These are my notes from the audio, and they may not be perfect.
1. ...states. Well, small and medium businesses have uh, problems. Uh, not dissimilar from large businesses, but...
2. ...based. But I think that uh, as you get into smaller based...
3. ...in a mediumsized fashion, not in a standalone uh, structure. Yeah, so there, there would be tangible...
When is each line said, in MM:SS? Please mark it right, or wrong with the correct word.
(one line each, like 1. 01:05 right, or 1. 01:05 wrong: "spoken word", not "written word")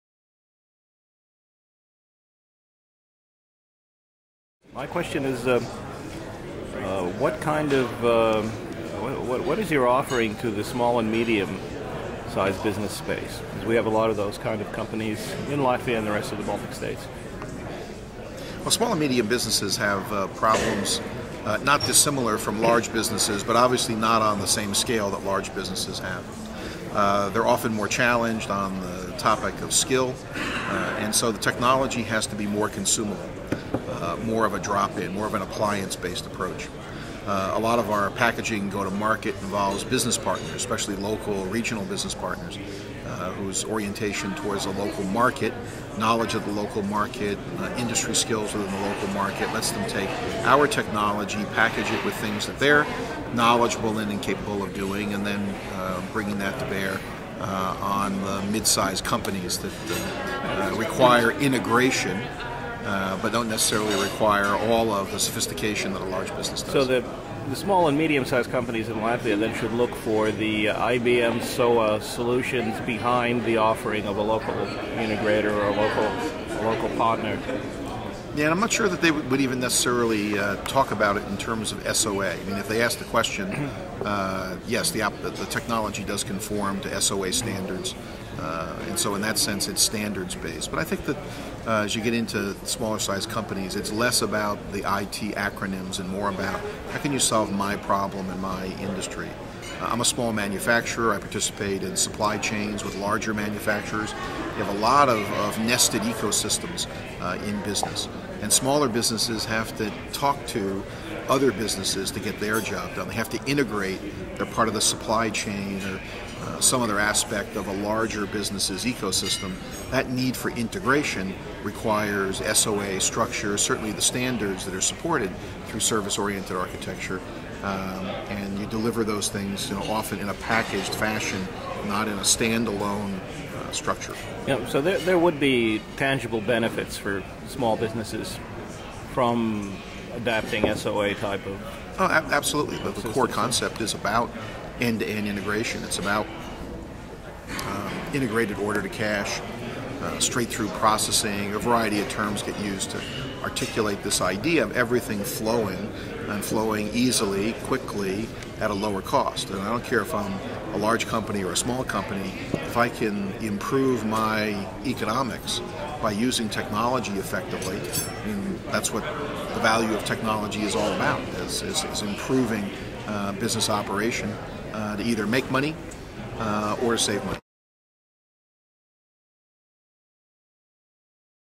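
1. 00:16 right
2. 01:30 wrong: "sized", not "based"
3. 02:10 wrong: "packaged", not "mediumsized".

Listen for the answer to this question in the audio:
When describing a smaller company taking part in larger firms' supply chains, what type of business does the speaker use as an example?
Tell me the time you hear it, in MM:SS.
01:40.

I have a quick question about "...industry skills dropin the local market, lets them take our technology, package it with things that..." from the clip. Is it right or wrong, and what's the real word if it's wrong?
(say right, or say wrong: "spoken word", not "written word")
wrong: "within", not "dropin".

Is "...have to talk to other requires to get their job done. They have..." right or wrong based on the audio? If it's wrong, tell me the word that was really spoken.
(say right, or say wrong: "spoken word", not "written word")
wrong: "businesses", not "requires".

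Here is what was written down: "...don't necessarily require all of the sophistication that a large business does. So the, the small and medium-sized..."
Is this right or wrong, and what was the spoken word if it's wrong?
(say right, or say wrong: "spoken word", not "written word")
right.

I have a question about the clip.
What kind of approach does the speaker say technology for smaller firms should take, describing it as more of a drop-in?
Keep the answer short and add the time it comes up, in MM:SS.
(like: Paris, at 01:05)
appliance-based, at 00:35.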